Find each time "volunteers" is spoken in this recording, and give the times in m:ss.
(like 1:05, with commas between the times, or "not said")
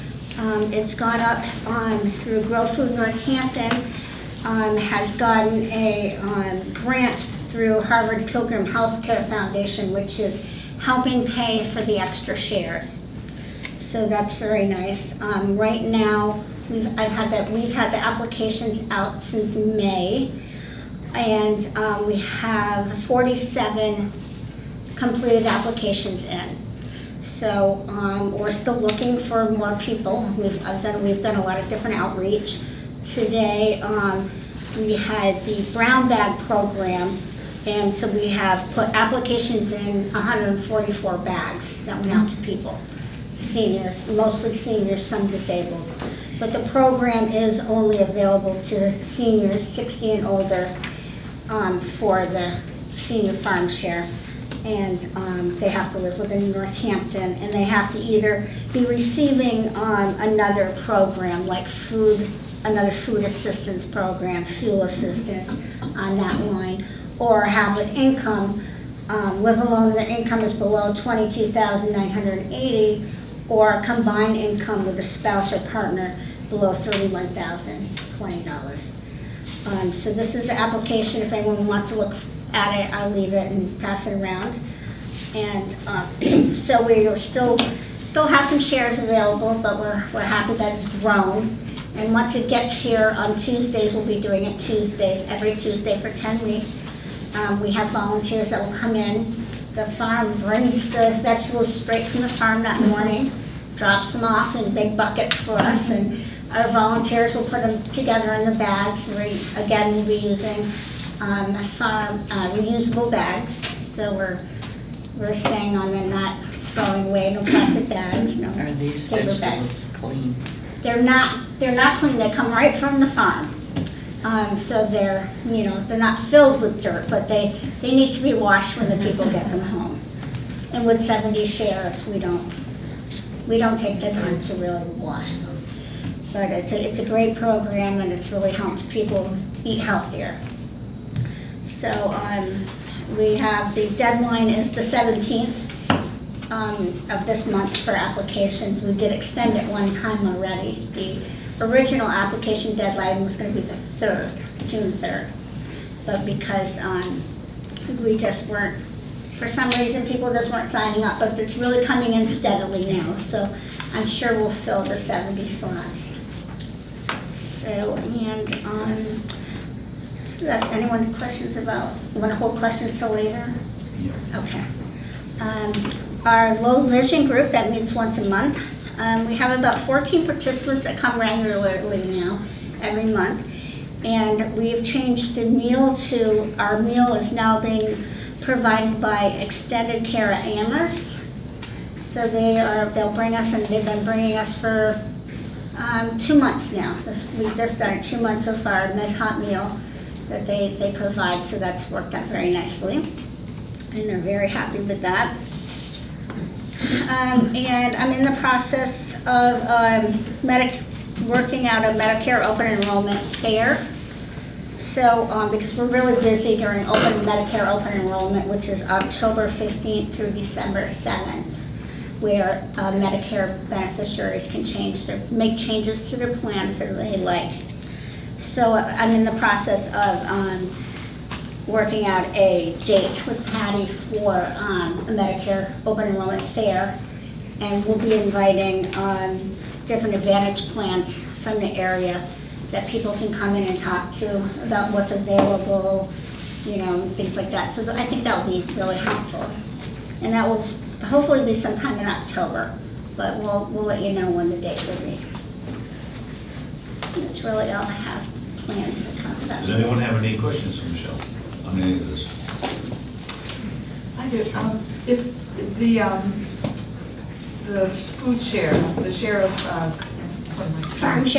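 1:37, 1:46.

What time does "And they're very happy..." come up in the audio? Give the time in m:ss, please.
3:23.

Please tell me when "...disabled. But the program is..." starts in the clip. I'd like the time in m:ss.
0:45.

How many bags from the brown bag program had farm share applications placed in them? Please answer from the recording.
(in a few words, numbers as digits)
144.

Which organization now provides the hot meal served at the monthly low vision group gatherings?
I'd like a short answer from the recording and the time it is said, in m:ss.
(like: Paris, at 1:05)
Extended Care at Amherst, at 3:09.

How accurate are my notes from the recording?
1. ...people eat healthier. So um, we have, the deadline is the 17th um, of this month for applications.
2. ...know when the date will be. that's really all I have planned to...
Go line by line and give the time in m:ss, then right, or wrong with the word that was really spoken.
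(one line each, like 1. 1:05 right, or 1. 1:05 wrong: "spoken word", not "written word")
1. 2:18 right
2. 4:14 right.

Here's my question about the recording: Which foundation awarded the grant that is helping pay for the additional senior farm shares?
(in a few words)
Harvard Pilgrim Healthcare Foundation.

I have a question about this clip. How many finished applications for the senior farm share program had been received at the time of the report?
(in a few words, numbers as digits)
47.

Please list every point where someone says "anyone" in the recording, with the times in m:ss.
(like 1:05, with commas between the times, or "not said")
1:21, 2:50, 4:19.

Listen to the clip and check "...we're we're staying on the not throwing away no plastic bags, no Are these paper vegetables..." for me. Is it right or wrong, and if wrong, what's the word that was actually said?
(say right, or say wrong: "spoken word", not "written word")
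right.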